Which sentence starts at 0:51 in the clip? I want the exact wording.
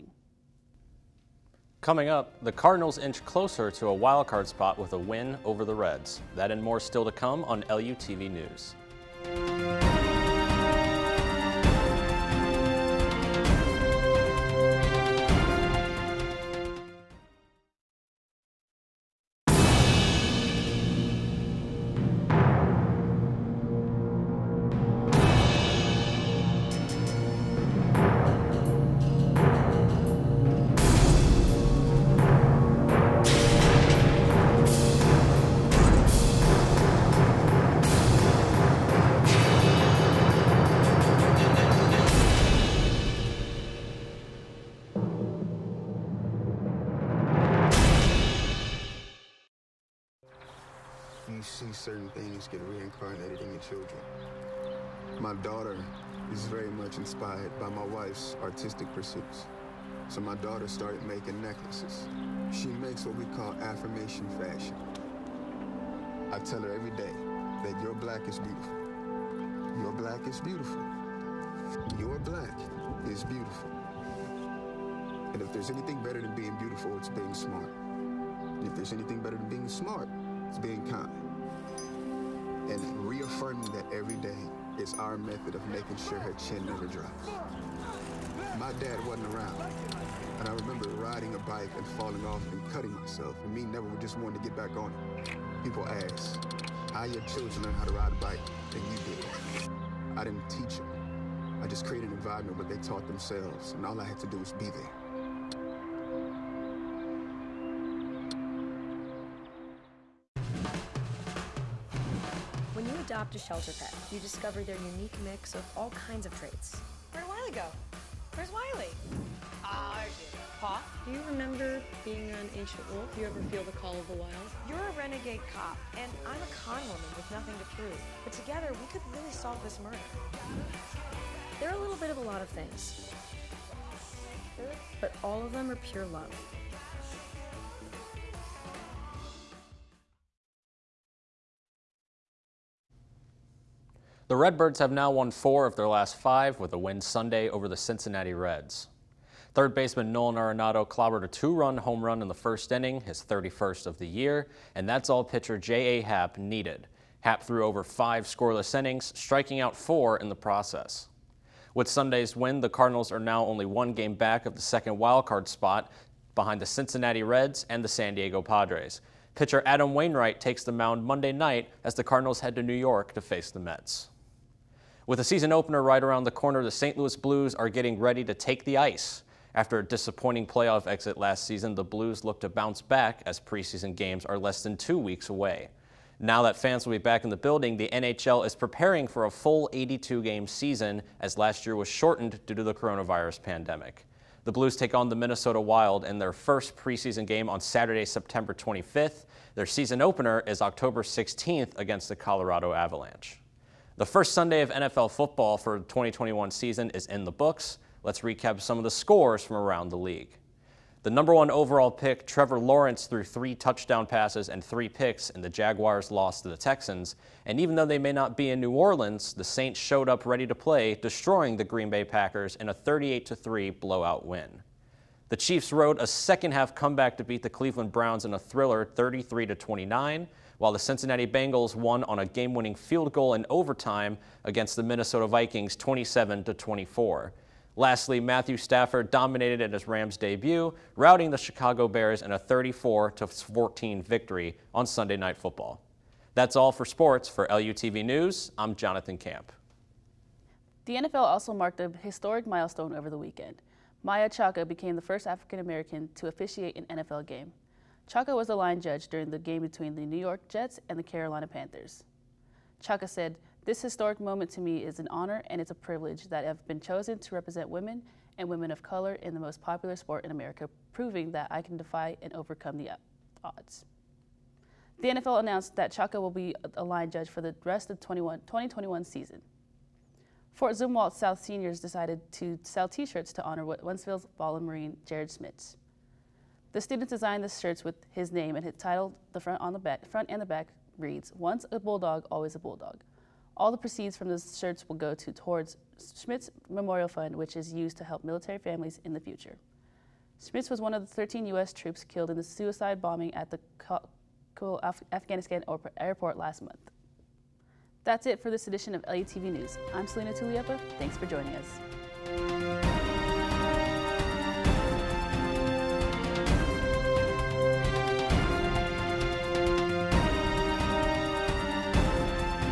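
certain things get reincarnated in your children.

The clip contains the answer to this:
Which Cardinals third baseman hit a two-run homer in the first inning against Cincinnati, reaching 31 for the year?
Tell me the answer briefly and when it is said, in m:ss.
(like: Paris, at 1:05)
Nolan Arenado, at 2:30.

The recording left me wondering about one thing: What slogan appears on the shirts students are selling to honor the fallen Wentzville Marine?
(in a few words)
Once a bulldog, always a bulldog.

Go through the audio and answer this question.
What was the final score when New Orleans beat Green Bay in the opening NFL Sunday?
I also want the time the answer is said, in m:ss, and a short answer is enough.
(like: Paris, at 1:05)
38-3, at 3:42.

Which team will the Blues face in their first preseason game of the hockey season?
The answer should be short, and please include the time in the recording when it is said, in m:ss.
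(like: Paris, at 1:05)
Minnesota Wild, at 3:15.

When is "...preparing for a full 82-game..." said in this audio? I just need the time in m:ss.
3:08.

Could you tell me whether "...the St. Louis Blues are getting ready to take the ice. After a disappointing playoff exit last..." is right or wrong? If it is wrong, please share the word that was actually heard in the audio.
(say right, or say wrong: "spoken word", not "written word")
right.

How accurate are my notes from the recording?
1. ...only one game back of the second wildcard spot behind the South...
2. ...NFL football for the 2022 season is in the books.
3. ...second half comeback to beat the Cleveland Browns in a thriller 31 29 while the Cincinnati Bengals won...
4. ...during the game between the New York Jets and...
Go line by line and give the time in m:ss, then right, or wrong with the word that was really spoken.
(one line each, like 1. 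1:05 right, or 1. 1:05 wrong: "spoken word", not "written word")
1. 2:43 wrong: "Cincinnati", not "South"
2. 3:24 wrong: "2021", not "2022"
3. 3:46 wrong: "33", not "31"
4. 4:19 right.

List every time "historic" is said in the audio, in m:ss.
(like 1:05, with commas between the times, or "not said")
4:12, 4:23.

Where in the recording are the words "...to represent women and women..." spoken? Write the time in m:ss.
4:27.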